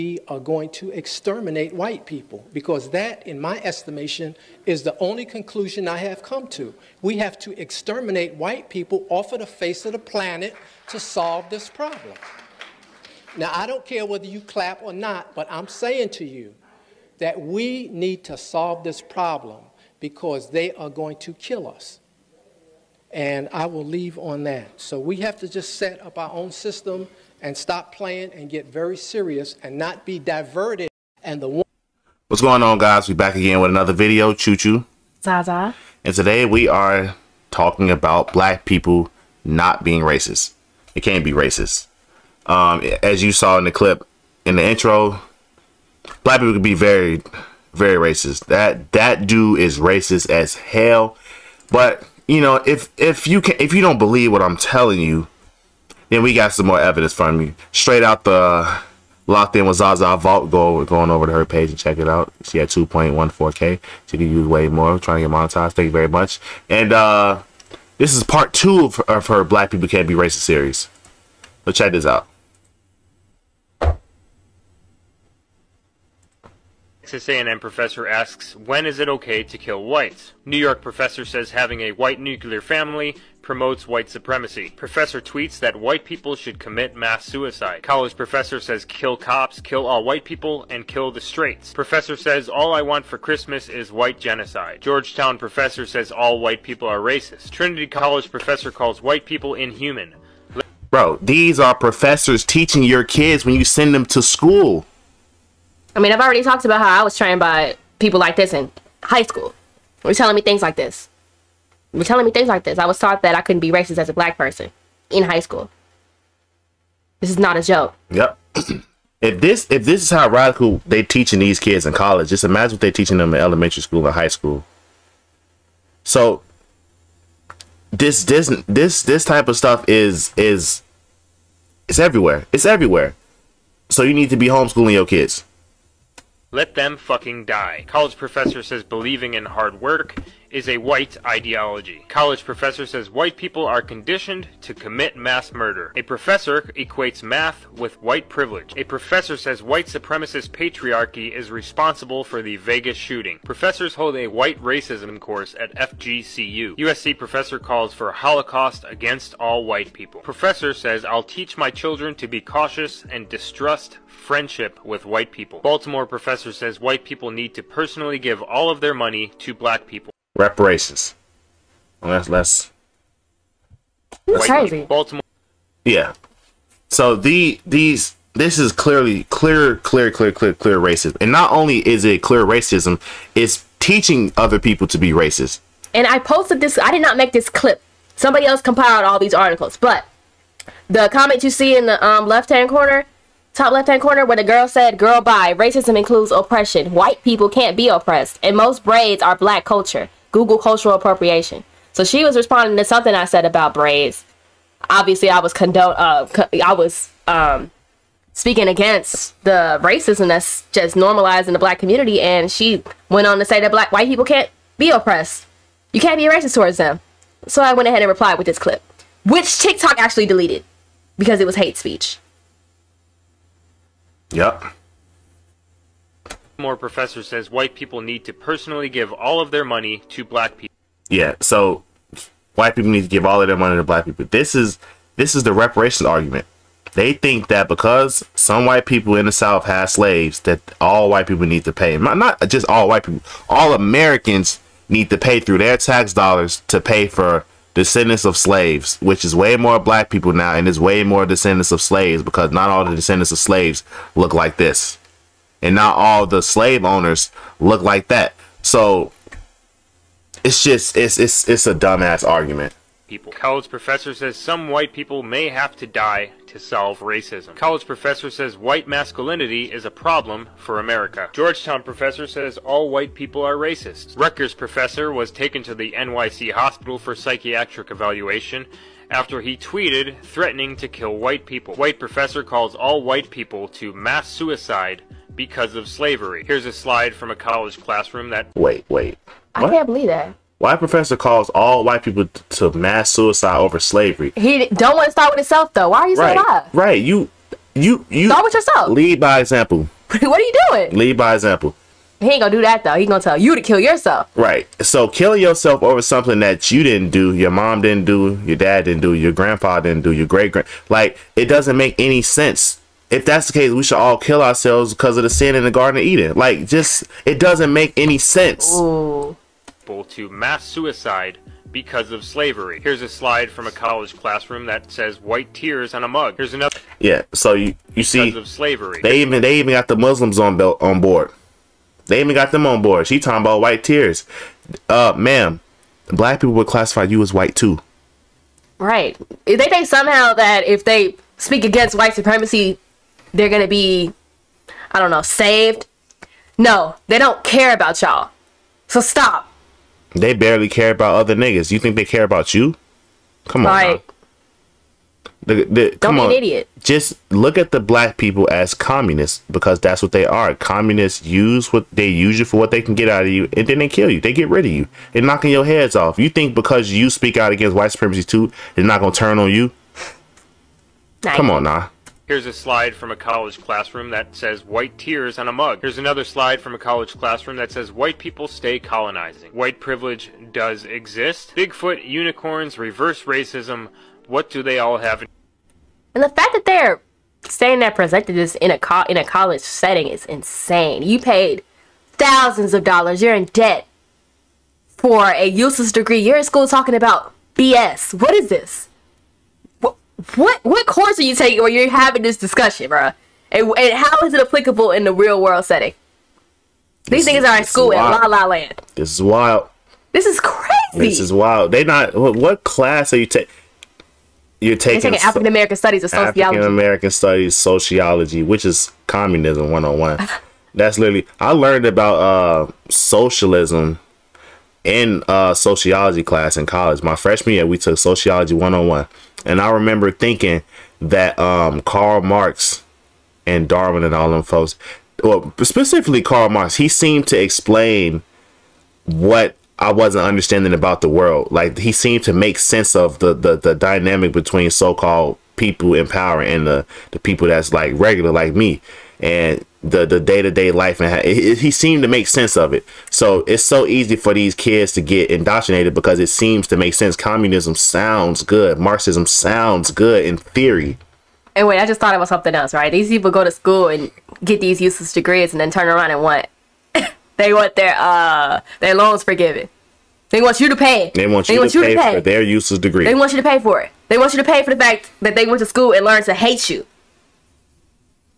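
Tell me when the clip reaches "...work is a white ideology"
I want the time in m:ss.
2:19.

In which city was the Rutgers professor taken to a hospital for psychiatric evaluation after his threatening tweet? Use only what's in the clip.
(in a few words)
NYC.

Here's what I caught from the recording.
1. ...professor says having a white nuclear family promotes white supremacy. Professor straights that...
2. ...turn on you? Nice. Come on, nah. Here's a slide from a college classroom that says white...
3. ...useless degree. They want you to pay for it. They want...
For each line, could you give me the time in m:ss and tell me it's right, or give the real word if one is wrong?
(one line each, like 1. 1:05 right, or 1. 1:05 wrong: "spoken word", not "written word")
1. 1:20 wrong: "tweets", not "straights"
2. 6:09 right
3. 7:52 right.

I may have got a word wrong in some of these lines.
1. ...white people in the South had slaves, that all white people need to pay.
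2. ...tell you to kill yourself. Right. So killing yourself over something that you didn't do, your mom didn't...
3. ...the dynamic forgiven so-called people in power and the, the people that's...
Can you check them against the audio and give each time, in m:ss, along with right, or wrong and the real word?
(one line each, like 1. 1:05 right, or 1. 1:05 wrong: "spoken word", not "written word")
1. 3:58 right
2. 5:03 right
3. 7:23 wrong: "between", not "forgiven".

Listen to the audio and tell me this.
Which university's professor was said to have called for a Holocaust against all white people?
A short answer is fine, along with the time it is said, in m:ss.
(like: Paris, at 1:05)
USC, at 2:36.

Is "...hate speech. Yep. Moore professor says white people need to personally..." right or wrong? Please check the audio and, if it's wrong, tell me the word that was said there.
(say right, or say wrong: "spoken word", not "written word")
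right.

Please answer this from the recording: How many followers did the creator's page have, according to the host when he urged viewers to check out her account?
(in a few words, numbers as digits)
2.14k.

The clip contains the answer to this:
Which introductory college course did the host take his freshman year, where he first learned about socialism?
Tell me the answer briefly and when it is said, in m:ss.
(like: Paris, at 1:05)
Sociology 101, at 7:07.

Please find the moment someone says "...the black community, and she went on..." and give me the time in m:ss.
3:31.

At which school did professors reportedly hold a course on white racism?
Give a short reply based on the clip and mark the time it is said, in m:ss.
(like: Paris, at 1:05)
FGCU, at 2:35.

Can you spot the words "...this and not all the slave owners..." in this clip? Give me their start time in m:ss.
4:14.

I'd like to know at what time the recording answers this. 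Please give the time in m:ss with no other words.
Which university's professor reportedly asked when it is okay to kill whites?
1:17.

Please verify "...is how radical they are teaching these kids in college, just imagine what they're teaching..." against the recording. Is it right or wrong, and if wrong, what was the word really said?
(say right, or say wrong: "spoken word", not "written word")
right.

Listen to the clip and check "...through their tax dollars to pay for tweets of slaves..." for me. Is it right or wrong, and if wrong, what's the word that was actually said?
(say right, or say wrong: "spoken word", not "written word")
wrong: "descendants", not "tweets".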